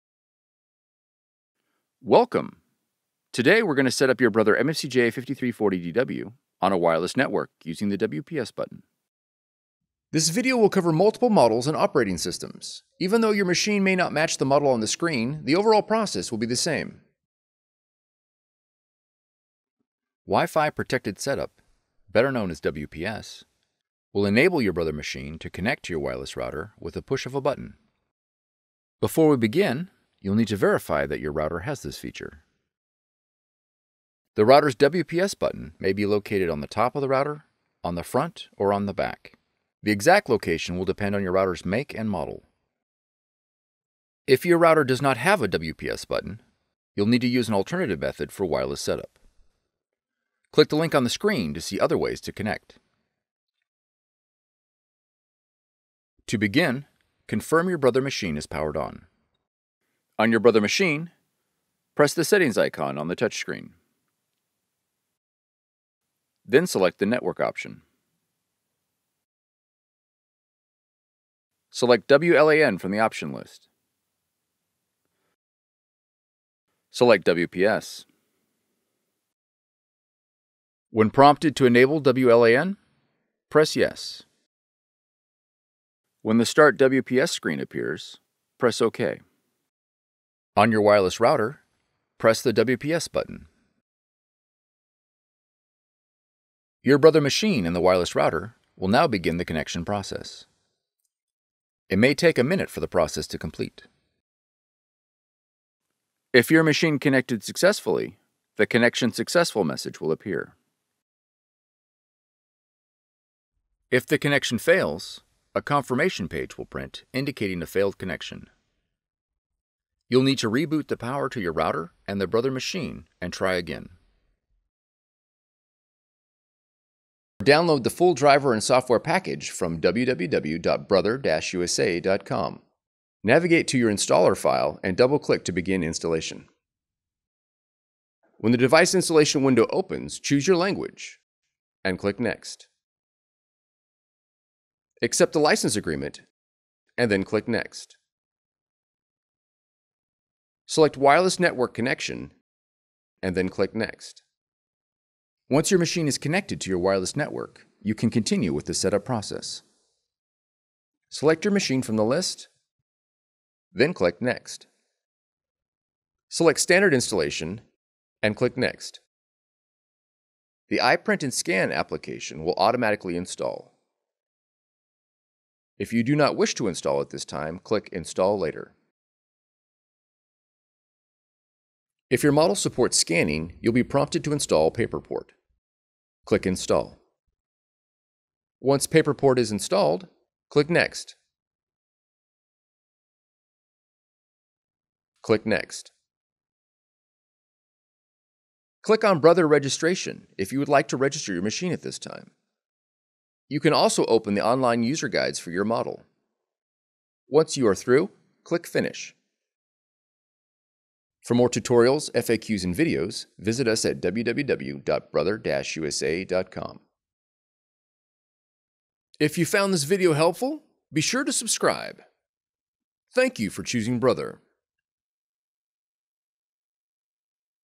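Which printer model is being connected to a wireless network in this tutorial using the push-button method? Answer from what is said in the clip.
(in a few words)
MFCJ5340DW.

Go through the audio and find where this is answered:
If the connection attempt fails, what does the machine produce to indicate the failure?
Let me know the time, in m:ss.
1:55.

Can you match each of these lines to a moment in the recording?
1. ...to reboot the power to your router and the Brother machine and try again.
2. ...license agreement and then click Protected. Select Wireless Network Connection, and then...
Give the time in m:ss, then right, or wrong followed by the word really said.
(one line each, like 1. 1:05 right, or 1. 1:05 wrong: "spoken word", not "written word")
1. 2:00 right
2. 2:25 wrong: "Next", not "Protected".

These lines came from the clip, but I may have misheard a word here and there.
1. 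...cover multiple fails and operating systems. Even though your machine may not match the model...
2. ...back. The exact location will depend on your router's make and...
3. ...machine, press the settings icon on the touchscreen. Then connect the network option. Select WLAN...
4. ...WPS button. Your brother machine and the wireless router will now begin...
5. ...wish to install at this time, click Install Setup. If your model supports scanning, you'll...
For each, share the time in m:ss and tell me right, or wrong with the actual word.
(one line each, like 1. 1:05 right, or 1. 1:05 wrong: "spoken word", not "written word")
1. 0:10 wrong: "models", not "fails"
2. 0:38 right
3. 1:00 wrong: "select", not "connect"
4. 1:32 right
5. 2:56 wrong: "Later", not "Setup".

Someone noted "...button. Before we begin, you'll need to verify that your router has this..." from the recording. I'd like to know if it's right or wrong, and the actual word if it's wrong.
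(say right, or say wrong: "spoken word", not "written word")
right.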